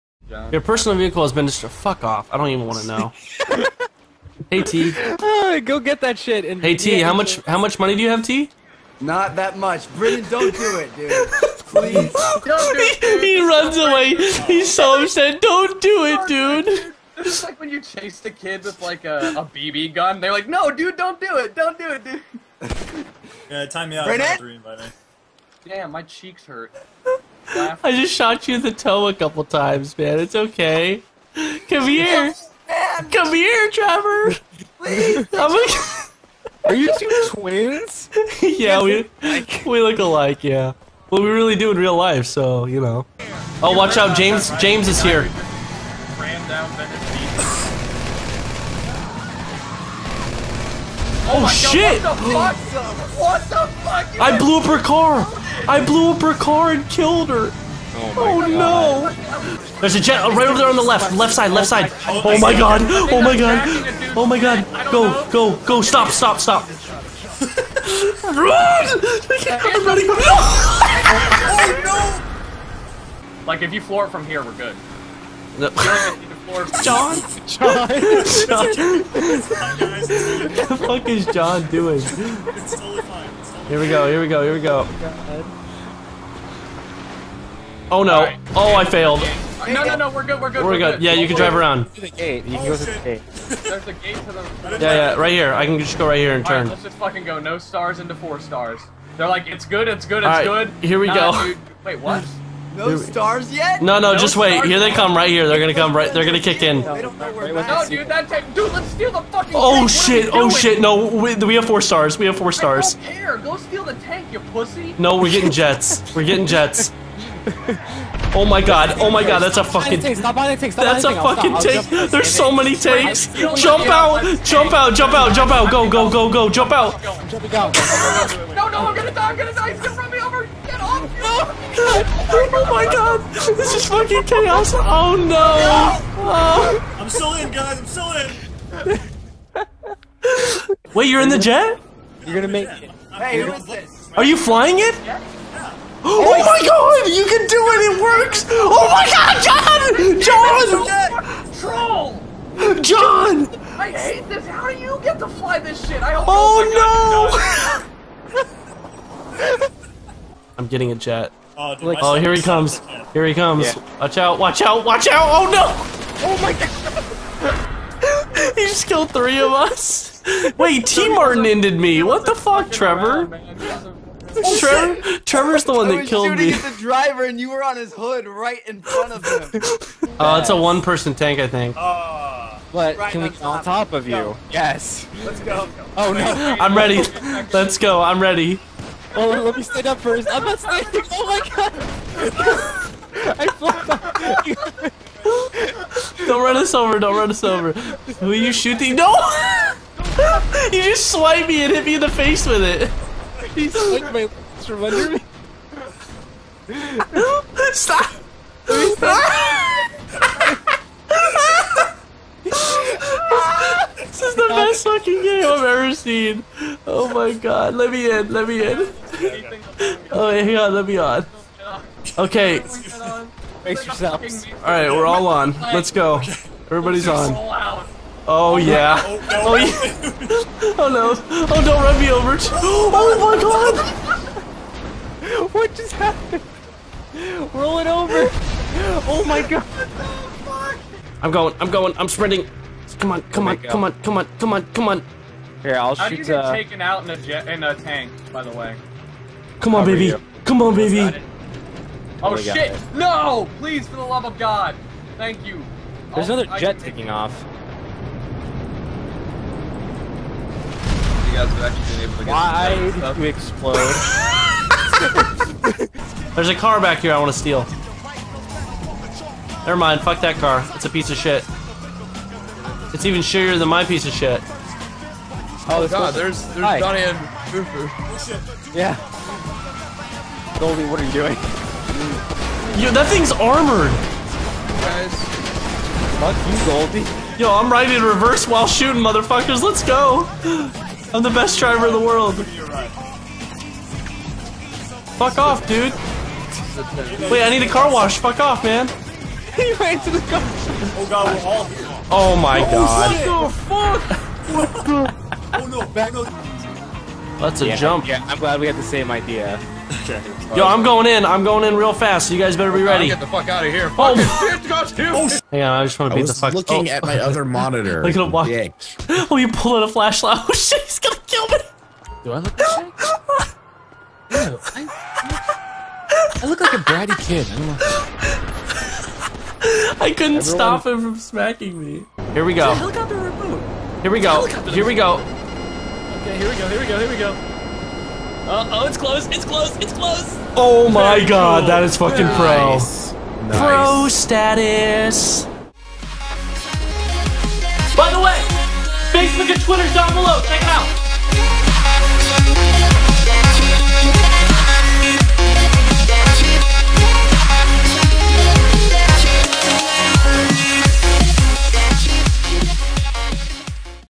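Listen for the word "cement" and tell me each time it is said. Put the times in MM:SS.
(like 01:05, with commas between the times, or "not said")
not said.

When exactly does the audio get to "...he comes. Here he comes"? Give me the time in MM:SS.
02:42.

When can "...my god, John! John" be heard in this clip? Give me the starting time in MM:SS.
02:28.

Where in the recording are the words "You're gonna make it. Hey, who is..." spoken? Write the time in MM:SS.
02:22.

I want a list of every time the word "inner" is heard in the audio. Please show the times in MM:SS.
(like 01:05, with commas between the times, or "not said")
not said.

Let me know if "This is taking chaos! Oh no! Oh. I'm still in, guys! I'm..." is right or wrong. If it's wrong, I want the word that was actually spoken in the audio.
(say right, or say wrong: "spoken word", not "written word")
wrong: "fucking", not "taking".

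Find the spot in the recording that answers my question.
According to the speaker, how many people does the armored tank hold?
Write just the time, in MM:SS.
03:00.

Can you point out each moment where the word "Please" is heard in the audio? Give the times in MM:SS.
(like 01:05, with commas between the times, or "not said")
00:11, 00:34, 04:13.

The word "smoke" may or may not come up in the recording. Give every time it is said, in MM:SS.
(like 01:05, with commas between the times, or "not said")
not said.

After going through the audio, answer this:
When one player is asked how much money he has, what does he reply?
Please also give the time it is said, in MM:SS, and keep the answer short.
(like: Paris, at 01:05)
Not that much, at 00:09.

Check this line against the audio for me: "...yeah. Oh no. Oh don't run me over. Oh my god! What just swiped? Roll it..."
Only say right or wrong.
wrong.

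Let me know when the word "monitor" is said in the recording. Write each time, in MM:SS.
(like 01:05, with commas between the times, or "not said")
05:17.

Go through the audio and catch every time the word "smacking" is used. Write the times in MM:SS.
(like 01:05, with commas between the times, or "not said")
05:31.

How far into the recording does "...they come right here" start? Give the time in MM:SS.
01:44.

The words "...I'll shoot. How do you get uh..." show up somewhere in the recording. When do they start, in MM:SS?
04:05.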